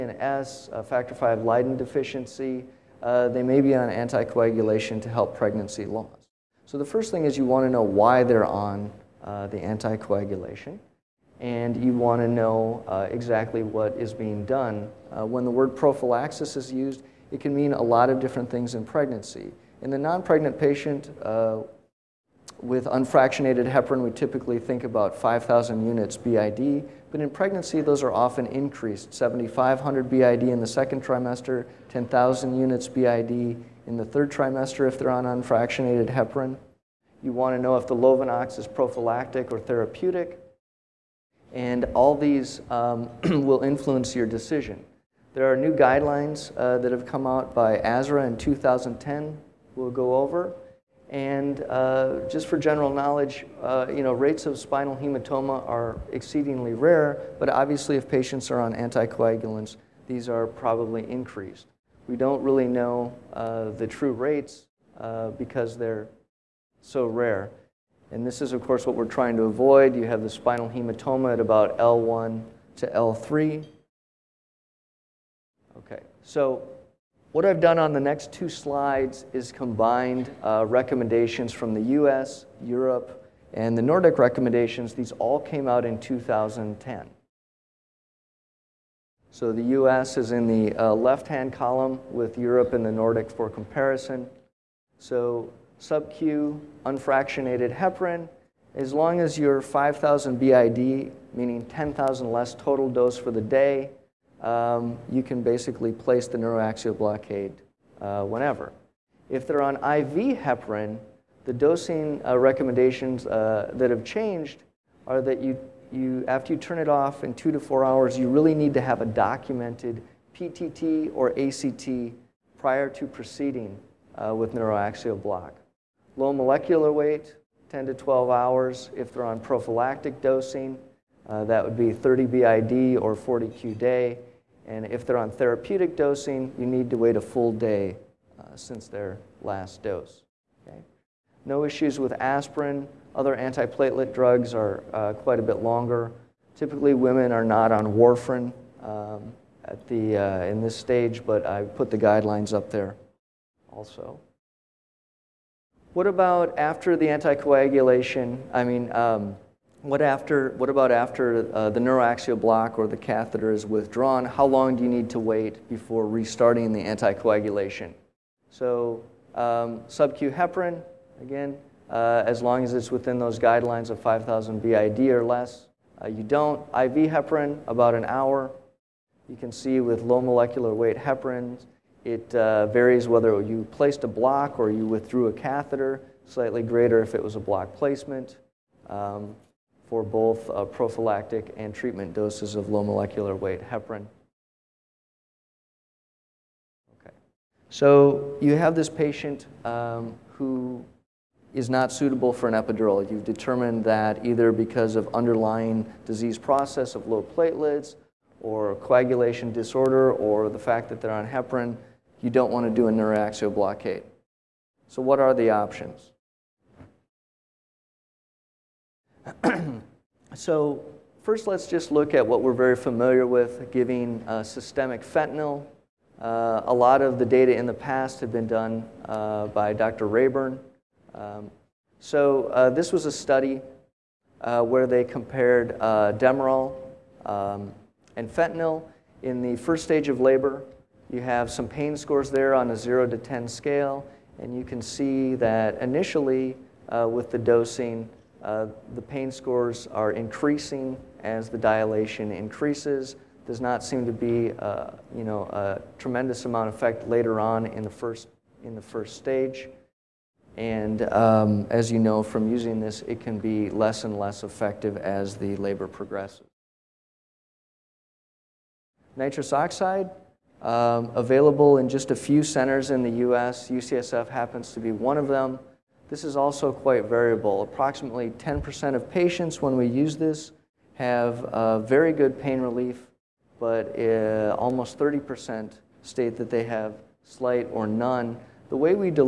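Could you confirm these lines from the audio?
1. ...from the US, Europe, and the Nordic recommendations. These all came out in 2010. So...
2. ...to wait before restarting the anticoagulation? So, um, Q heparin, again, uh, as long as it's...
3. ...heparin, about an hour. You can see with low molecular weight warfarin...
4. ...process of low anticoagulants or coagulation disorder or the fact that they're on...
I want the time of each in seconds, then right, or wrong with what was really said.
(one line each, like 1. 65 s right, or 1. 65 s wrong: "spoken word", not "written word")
1. 81 s right
2. 165 s right
3. 177 s wrong: "heparin", not "warfarin"
4. 206 s wrong: "platelets", not "anticoagulants".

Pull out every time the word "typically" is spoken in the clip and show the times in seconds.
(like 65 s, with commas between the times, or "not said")
24 s, 146 s.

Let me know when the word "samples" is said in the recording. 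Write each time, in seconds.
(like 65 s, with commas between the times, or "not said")
not said.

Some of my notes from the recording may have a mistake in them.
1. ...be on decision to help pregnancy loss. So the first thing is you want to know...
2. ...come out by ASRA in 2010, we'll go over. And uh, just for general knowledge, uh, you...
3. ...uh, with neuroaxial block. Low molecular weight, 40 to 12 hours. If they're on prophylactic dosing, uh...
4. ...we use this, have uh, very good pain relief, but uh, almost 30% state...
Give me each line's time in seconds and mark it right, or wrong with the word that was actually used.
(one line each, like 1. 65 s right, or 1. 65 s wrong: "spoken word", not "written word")
1. 3 s wrong: "anticoagulation", not "decision"
2. 47 s right
3. 124 s wrong: "10", not "40"
4. 279 s right.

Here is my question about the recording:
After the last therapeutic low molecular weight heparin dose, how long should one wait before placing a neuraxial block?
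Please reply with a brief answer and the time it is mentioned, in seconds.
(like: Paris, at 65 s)
a full day, at 137 s.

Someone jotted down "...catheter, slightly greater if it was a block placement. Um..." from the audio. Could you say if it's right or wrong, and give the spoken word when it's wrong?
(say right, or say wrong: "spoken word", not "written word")
right.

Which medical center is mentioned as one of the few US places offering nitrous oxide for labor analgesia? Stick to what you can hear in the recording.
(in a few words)
UCSF.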